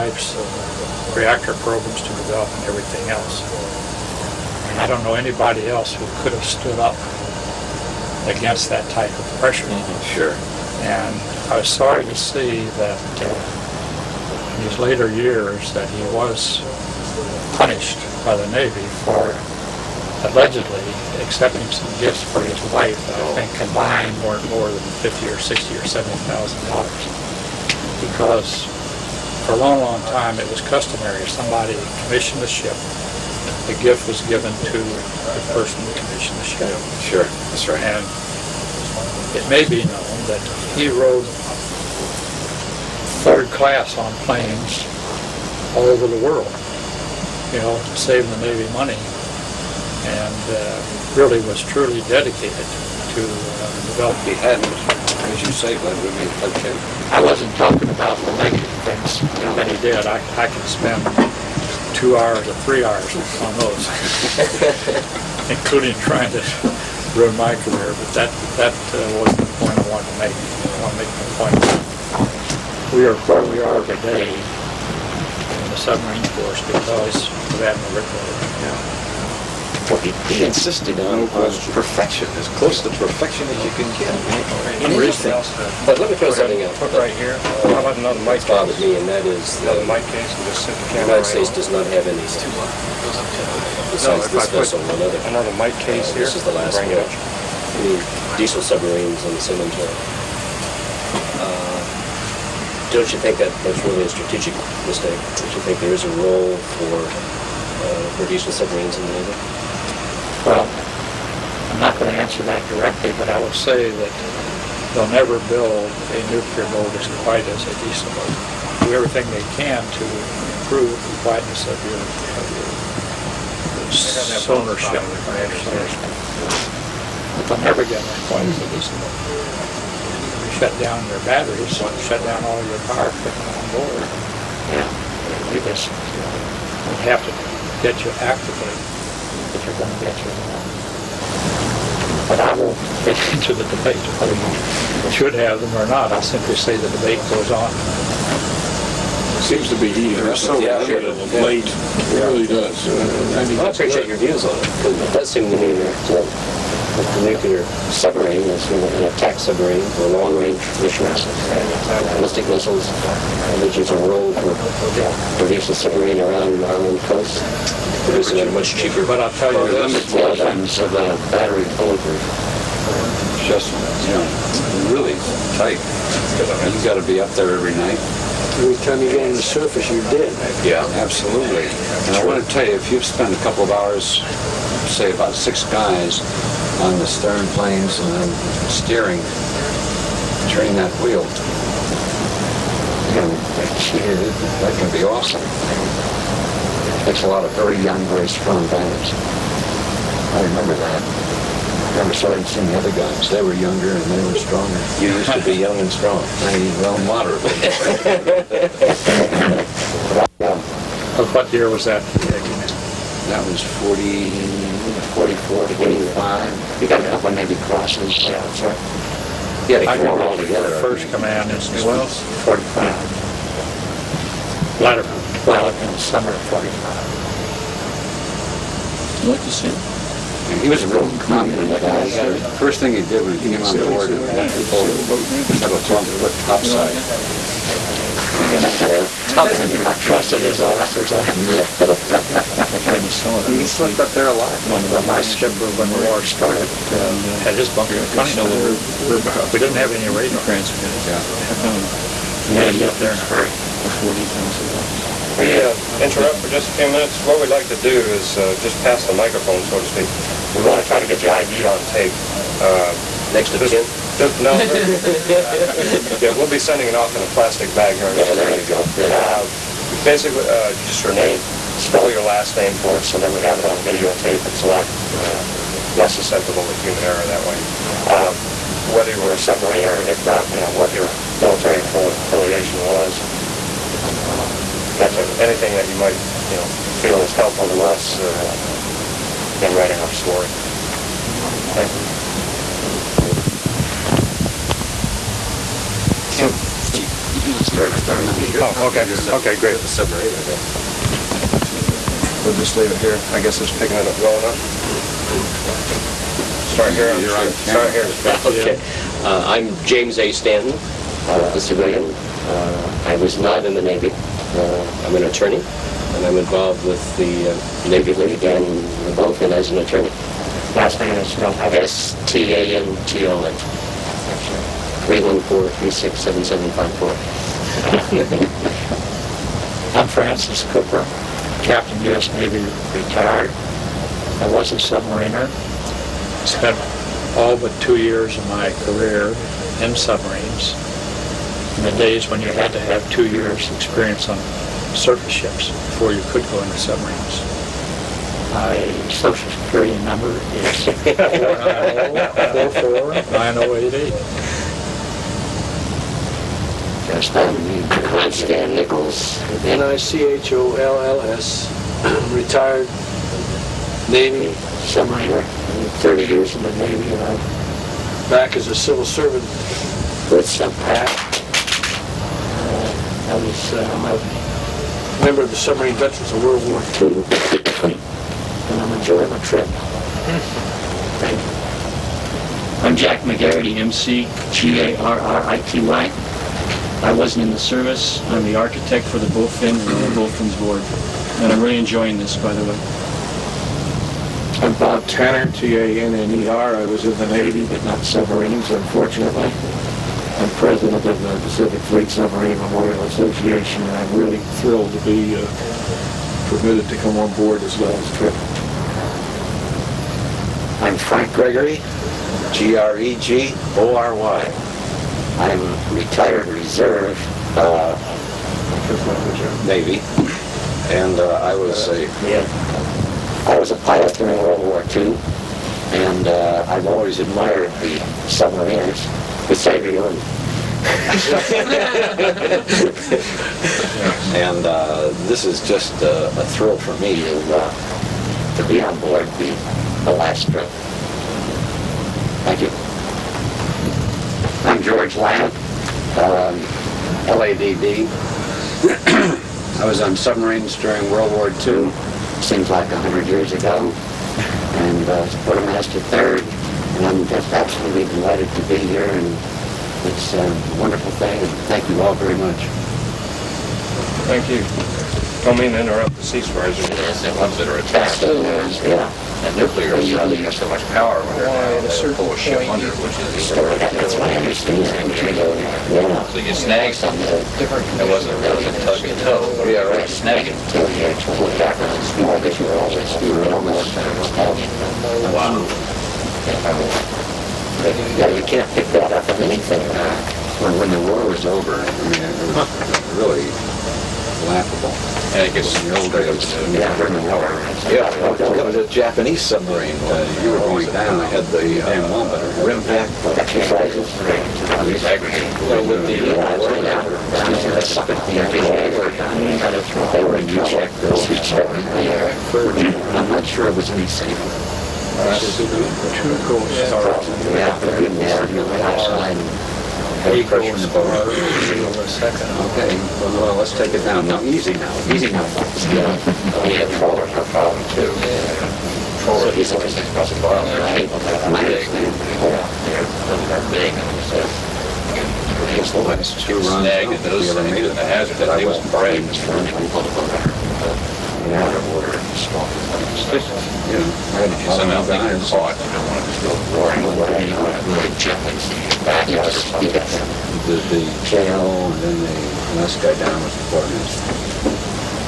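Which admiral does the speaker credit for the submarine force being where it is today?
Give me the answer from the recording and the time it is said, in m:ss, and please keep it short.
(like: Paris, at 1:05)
Admiral Rickover, at 1:17.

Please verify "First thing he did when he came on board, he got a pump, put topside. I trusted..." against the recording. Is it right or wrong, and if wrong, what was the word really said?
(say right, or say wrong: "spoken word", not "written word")
right.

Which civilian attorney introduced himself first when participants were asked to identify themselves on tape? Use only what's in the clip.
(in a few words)
James A. Stanton.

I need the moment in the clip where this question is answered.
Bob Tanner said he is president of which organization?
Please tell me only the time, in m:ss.
6:41.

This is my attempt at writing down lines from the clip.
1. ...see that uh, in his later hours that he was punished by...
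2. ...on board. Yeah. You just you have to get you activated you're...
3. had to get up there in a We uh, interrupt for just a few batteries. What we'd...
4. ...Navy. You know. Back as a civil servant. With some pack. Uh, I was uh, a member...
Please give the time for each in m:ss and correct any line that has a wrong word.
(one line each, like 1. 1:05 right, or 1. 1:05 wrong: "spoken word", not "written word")
1. 0:12 wrong: "years", not "hours"
2. 2:13 right
3. 4:12 wrong: "minutes", not "batteries"
4. 6:06 right.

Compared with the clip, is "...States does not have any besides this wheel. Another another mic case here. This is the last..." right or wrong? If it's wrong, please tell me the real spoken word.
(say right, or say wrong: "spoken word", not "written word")
wrong: "vessel", not "wheel".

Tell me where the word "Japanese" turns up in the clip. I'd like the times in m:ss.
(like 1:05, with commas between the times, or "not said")
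8:18.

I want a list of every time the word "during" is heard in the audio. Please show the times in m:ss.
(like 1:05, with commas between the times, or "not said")
7:04, 7:30.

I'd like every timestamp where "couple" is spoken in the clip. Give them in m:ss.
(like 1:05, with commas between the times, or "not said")
3:03, 3:37.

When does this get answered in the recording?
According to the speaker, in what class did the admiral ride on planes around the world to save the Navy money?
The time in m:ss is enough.
0:43.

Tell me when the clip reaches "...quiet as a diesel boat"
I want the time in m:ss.
2:08.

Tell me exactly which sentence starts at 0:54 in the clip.
the hadn't as you say, that would be okay.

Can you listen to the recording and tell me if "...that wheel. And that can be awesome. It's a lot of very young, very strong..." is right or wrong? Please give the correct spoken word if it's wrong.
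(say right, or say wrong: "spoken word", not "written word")
right.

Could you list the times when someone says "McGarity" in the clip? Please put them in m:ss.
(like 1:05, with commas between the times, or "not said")
6:23.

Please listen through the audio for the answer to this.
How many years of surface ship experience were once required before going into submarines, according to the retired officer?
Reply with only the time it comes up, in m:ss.
5:43.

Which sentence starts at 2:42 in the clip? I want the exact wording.
Ballistic missiles, which is a role for yeah, submarine around our own coast.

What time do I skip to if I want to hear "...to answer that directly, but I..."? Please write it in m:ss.
1:52.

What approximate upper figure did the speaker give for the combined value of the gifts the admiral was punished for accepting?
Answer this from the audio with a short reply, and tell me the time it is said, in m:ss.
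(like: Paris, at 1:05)
$70,000, at 0:25.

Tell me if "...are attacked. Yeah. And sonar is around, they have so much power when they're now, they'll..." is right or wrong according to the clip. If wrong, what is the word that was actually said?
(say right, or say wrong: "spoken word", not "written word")
wrong: "nuclear", not "sonar".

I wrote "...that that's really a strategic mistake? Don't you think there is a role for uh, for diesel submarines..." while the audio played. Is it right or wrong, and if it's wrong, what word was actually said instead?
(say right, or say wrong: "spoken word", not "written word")
right.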